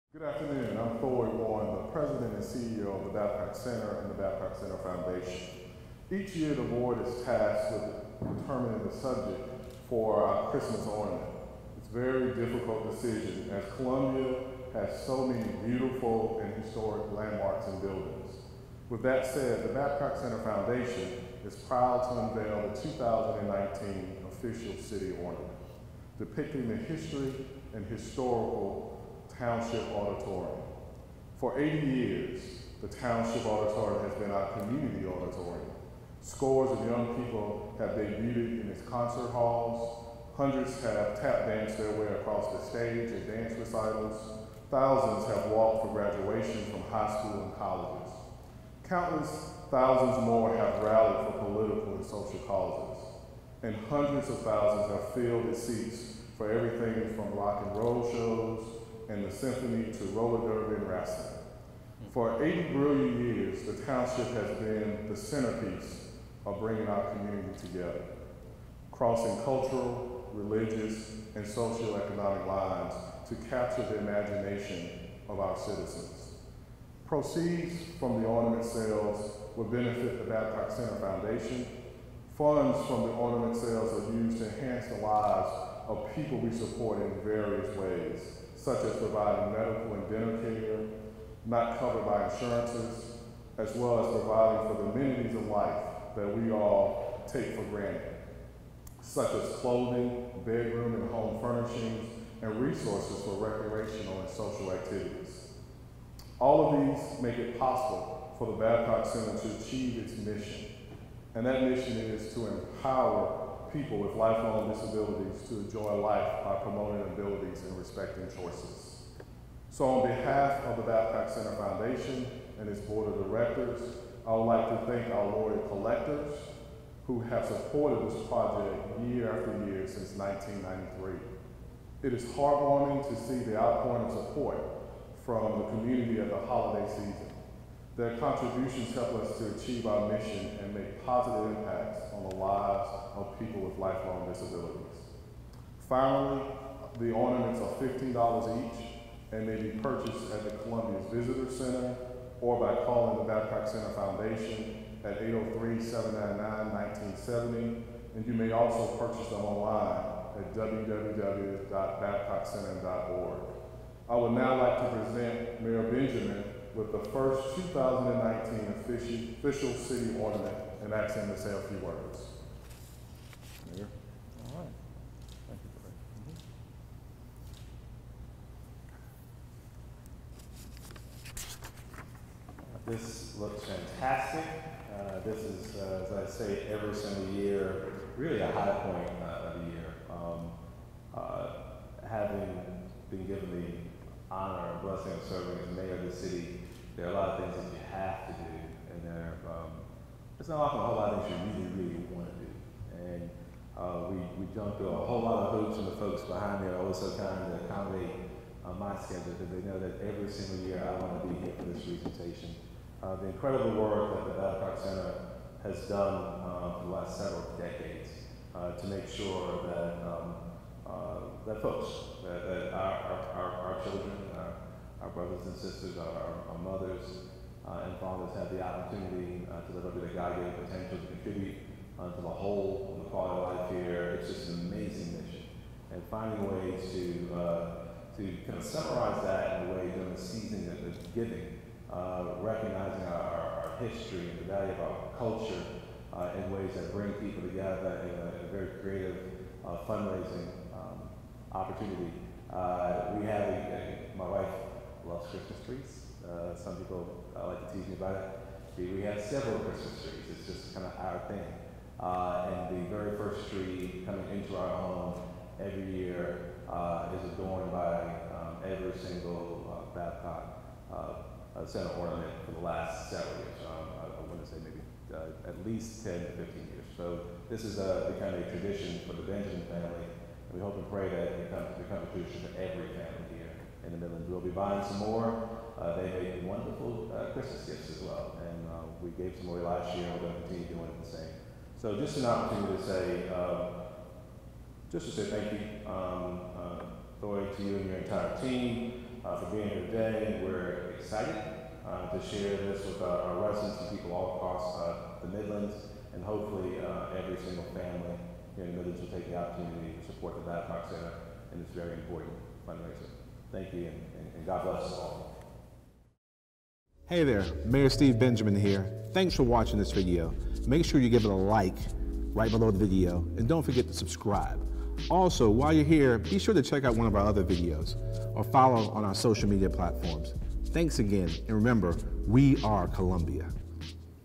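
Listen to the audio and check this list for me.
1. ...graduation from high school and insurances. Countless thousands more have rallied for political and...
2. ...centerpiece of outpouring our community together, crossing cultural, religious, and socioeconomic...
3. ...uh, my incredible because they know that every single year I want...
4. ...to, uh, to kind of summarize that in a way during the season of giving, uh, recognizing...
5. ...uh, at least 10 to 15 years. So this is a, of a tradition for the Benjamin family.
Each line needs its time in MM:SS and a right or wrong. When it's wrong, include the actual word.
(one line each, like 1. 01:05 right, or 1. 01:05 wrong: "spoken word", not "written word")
1. 00:45 wrong: "colleges", not "insurances"
2. 01:05 wrong: "bringing", not "outpouring"
3. 03:28 wrong: "schedule", not "incredible"
4. 03:56 right
5. 04:35 right.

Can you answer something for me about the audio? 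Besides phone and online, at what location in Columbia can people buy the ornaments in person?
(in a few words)
Columbia's Visitor Center.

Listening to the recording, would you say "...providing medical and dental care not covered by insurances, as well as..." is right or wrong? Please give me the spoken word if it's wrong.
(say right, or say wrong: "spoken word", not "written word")
right.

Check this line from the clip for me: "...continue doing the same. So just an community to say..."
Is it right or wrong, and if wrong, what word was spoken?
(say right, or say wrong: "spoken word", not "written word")
wrong: "opportunity", not "community".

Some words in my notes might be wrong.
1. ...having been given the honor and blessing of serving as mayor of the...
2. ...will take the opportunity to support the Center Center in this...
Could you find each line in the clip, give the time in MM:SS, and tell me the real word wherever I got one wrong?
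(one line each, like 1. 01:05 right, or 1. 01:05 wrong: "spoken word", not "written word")
1. 03:12 right
2. 05:09 wrong: "Babcock", not "Center".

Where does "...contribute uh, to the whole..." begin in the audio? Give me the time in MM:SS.
03:51.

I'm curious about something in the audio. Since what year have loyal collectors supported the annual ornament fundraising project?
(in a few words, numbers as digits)
1993.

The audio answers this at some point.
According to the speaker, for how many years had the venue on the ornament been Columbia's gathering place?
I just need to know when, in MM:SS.
00:31.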